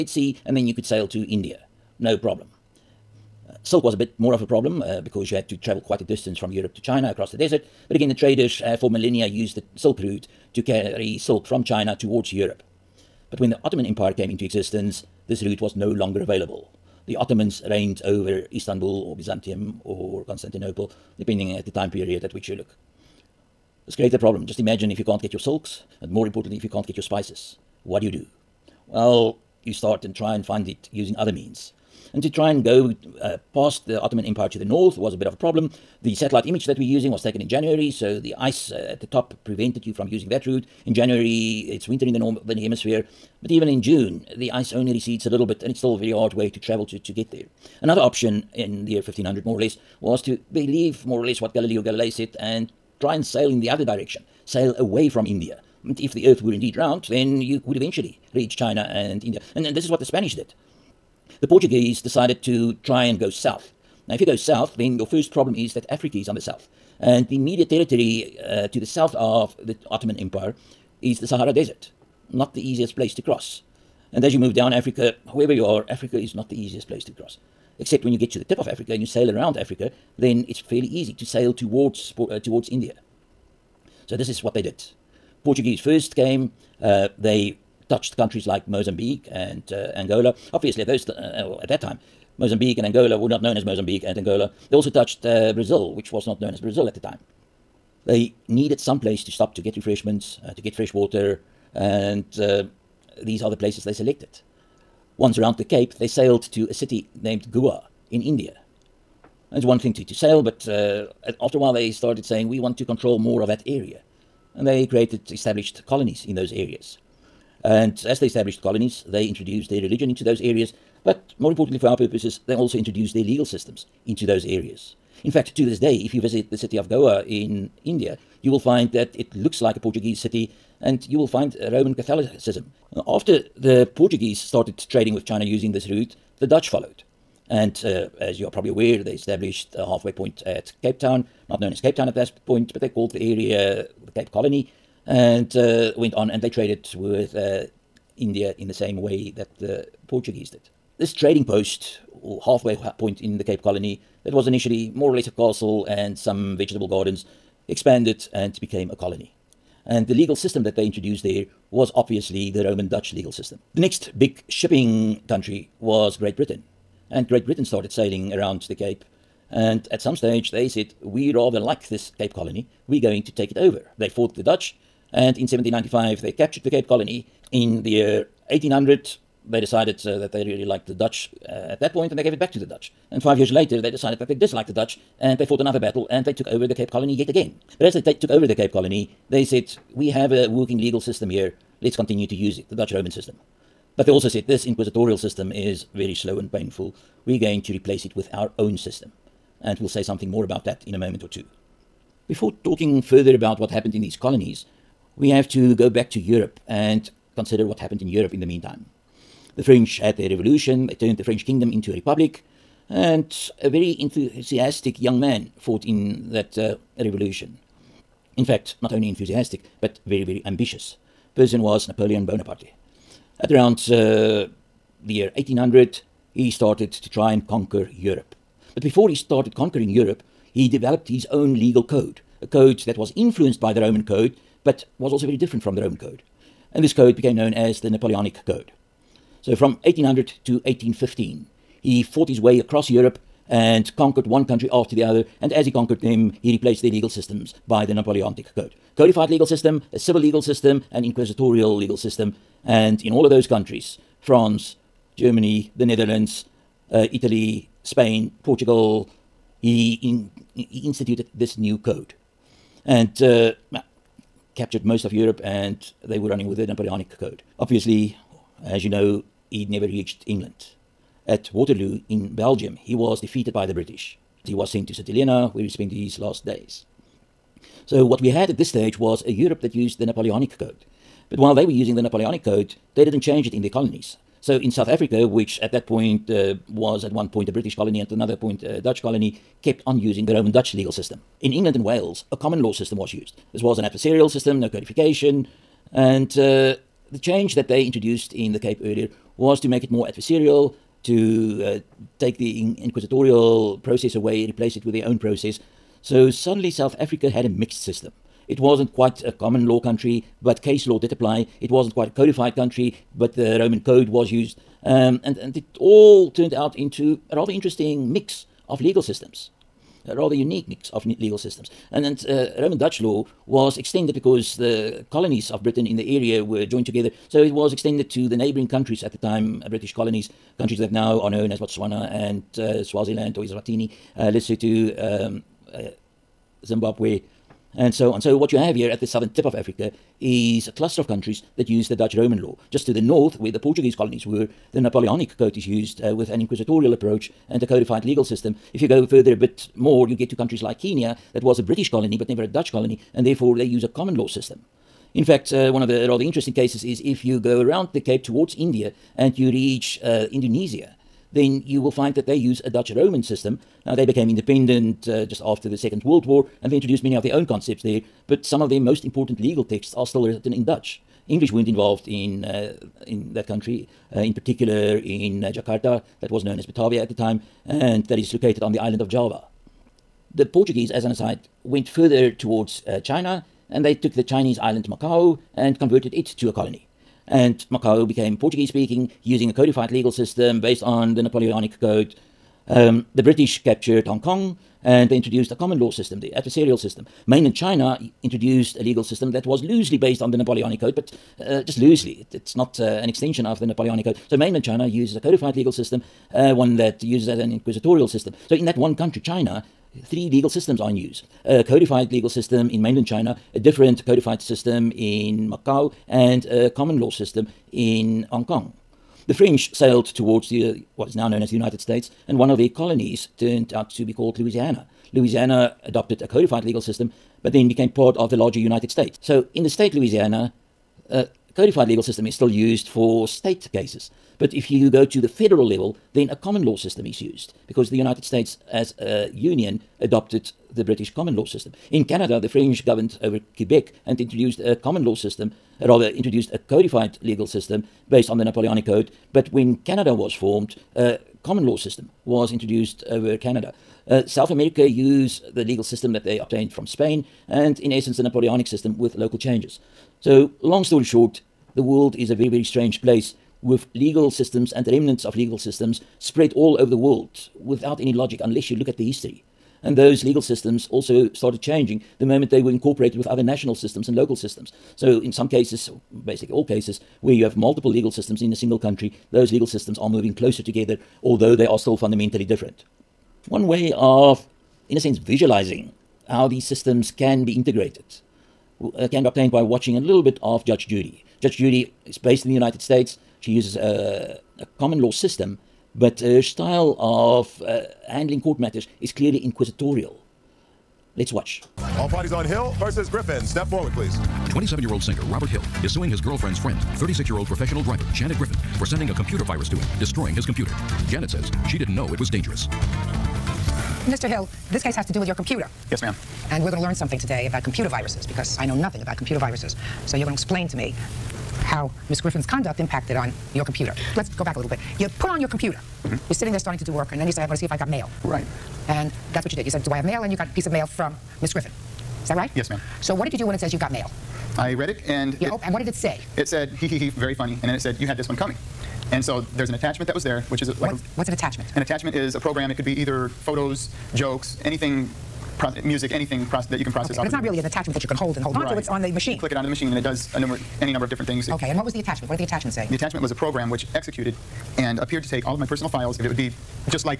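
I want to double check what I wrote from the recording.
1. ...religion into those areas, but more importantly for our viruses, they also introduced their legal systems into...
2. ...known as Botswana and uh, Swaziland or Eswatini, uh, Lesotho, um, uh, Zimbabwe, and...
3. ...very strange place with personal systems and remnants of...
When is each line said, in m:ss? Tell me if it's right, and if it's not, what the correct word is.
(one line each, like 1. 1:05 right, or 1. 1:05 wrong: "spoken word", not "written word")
1. 1:59 wrong: "purposes", not "viruses"
2. 5:31 right
3. 7:42 wrong: "legal", not "personal".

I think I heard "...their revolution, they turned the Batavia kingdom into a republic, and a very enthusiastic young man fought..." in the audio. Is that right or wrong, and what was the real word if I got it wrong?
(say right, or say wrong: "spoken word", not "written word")
wrong: "French", not "Batavia".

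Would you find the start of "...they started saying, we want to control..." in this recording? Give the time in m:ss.
1:51.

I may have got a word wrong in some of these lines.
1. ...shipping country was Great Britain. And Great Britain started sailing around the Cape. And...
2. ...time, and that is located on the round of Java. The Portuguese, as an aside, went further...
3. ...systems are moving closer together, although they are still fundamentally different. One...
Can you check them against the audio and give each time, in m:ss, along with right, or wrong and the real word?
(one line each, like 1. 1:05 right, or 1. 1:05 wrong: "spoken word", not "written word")
1. 2:44 right
2. 6:17 wrong: "island", not "round"
3. 7:59 right.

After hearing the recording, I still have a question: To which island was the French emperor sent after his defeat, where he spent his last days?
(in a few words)
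St. Helena.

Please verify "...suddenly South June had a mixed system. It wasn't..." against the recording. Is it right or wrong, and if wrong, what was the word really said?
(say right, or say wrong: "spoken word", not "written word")
wrong: "Africa", not "June".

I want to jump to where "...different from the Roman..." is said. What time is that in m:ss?
3:55.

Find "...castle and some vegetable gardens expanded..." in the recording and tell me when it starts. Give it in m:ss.
2:35.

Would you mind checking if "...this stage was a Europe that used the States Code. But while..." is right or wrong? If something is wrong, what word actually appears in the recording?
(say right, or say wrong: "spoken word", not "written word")
wrong: "Napoleonic", not "States".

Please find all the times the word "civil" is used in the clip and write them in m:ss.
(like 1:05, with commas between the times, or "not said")
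4:09.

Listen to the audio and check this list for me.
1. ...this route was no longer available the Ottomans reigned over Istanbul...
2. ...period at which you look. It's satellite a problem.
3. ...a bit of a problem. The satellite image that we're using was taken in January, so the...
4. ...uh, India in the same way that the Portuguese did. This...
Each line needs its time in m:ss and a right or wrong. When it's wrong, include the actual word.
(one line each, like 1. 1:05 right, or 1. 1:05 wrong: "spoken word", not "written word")
1. 0:15 right
2. 0:21 wrong: "create", not "satellite"
3. 0:35 right
4. 2:27 right.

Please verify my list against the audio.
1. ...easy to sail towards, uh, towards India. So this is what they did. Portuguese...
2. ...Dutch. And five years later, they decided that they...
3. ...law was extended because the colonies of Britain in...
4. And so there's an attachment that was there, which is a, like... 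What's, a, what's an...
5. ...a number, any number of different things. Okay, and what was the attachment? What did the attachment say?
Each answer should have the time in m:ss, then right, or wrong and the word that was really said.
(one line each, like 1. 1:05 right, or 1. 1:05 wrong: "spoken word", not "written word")
1. 1:20 right
2. 3:02 right
3. 5:23 right
4. 8:59 right
5. 9:10 right.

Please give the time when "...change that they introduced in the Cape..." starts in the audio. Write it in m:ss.
4:57.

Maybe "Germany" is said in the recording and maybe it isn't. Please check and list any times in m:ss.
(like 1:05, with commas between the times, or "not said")
4:15.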